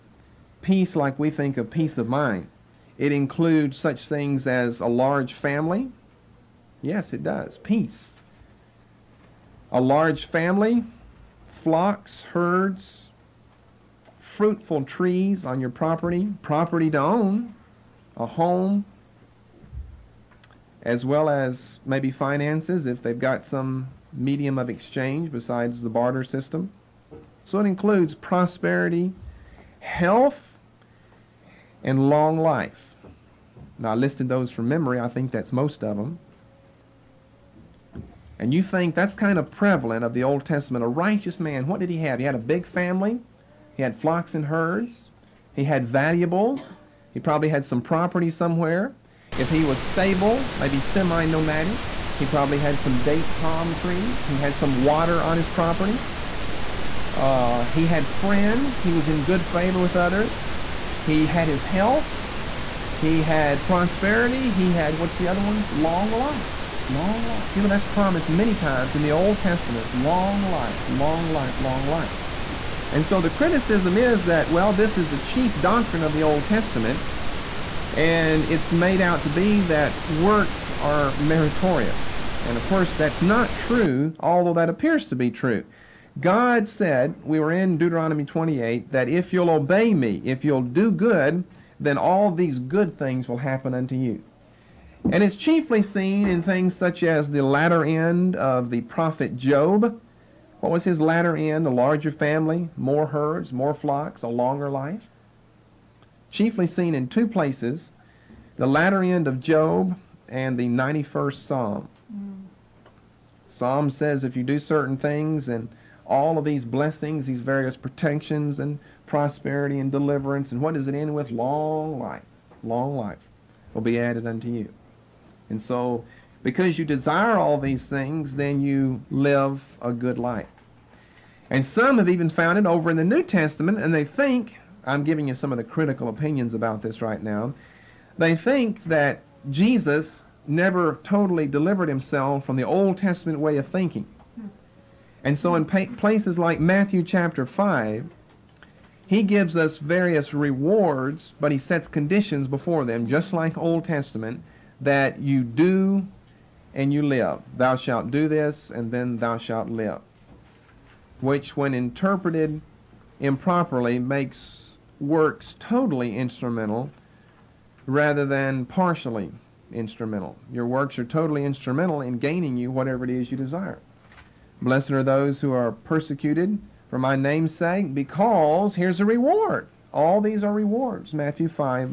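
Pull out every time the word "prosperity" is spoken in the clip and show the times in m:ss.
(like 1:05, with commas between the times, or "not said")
0:28, 1:03, 1:59.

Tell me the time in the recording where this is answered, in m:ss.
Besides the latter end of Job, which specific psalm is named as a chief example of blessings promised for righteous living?
1:50.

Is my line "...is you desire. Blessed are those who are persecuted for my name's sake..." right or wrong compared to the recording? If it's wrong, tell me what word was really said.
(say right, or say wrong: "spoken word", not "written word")
right.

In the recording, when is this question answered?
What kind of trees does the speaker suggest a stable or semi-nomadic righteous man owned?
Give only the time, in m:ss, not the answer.
0:53.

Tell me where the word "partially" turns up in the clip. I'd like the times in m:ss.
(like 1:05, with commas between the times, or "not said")
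2:48.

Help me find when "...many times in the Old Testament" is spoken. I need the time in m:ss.
1:08.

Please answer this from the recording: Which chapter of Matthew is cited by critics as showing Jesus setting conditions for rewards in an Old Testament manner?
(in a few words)
Matthew 5.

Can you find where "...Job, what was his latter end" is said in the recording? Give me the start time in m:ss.
1:39.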